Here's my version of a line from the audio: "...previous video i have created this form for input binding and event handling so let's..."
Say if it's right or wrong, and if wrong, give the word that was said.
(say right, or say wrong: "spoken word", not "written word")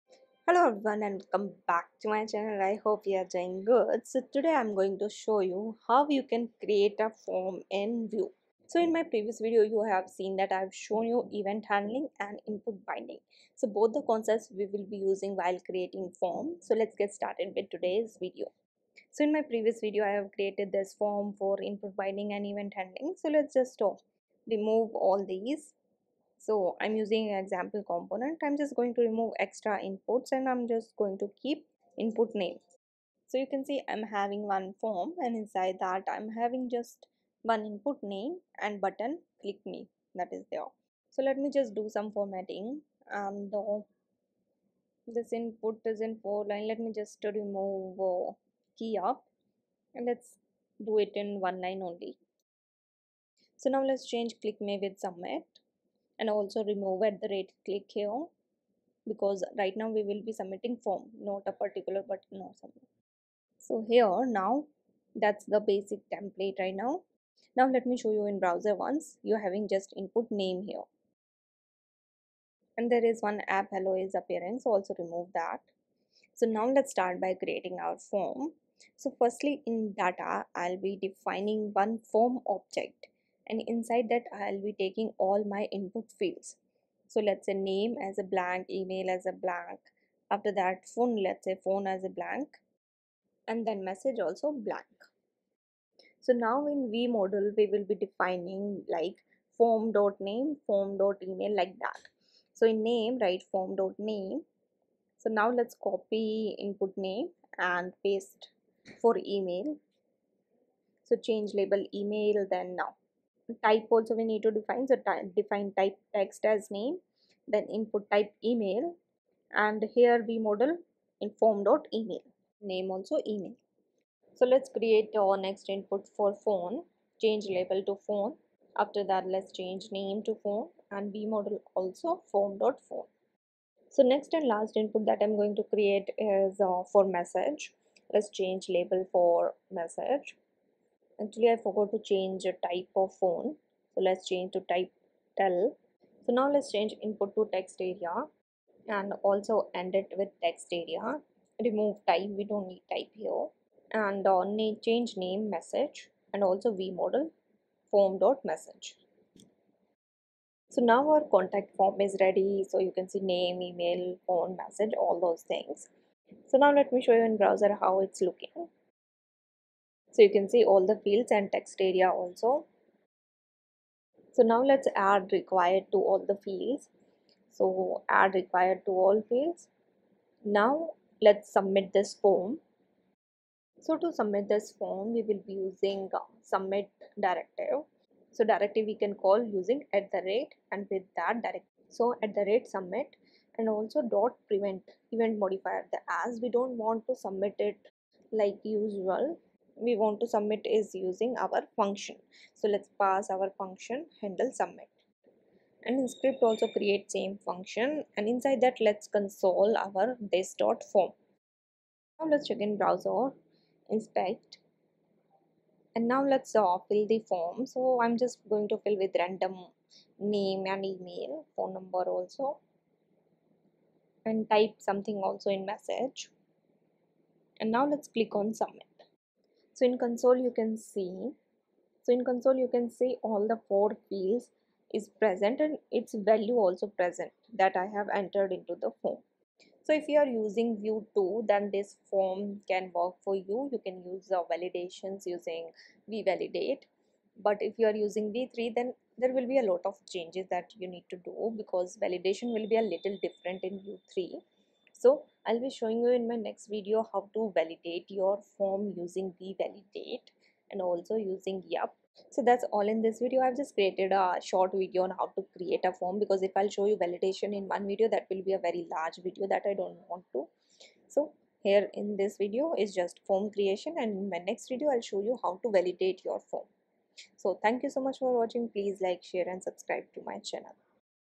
right.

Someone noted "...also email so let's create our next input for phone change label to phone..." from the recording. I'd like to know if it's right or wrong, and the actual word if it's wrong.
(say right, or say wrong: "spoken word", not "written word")
right.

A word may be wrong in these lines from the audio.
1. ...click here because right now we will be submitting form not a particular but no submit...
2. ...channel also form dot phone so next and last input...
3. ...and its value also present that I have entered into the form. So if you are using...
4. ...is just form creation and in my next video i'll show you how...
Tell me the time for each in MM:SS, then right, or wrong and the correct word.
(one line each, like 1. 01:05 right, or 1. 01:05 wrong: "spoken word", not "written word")
1. 00:57 right
2. 02:11 wrong: "model", not "channel"
3. 03:55 right
4. 04:32 right.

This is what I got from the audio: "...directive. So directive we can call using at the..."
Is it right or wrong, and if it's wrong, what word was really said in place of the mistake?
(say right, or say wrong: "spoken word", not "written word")
right.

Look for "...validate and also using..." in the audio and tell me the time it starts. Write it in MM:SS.
04:19.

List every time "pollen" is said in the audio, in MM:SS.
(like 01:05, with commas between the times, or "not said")
not said.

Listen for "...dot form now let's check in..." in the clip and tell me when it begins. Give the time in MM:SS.
03:30.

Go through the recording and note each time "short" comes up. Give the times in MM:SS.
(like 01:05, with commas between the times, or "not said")
04:24.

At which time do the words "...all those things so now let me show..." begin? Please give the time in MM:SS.
02:45.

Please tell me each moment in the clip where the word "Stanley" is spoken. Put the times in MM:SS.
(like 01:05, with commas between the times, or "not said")
not said.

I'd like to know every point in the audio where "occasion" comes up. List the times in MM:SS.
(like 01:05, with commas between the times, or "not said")
not said.